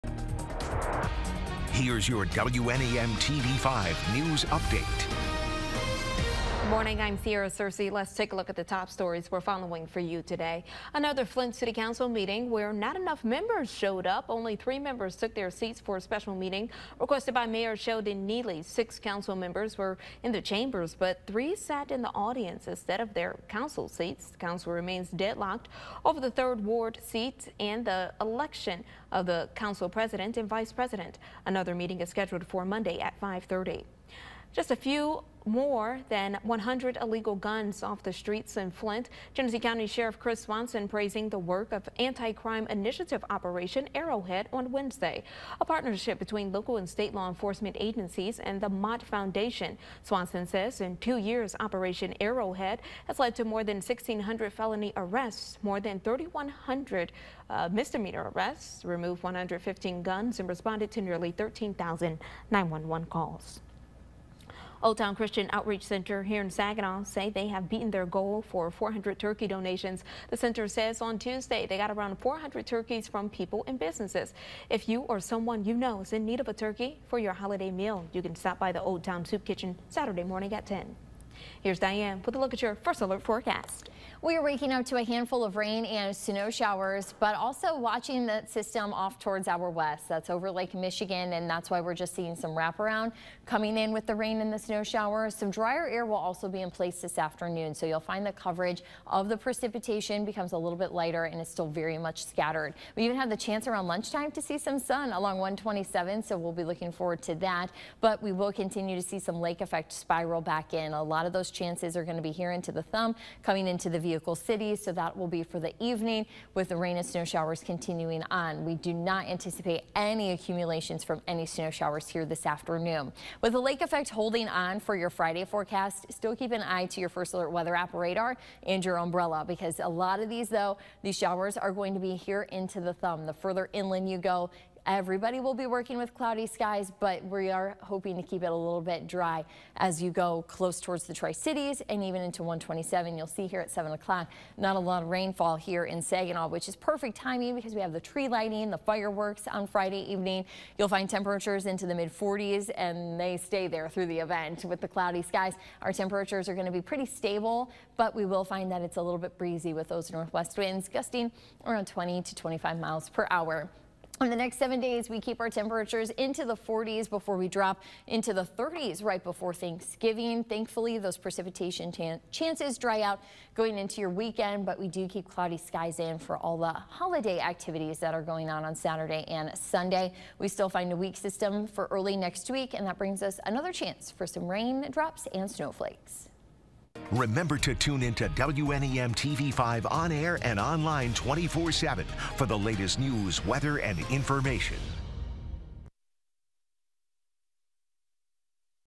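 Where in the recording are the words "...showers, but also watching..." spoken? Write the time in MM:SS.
01:26.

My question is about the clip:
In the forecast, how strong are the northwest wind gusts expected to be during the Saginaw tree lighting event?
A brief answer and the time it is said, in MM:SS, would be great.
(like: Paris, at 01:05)
20 to 25 mph, at 02:41.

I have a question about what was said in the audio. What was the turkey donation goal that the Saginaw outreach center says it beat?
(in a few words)
400.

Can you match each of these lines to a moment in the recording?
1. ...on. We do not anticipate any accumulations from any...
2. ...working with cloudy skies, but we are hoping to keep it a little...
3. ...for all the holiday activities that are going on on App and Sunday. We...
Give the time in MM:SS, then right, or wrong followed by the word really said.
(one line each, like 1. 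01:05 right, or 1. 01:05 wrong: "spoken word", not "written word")
1. 01:58 right
2. 02:15 right
3. 02:56 wrong: "Saturday", not "App".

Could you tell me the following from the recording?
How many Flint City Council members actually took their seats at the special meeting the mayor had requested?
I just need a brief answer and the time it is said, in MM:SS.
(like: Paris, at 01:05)
3, at 00:14.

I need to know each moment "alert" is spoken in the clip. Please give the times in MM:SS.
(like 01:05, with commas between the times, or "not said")
01:23, 02:07.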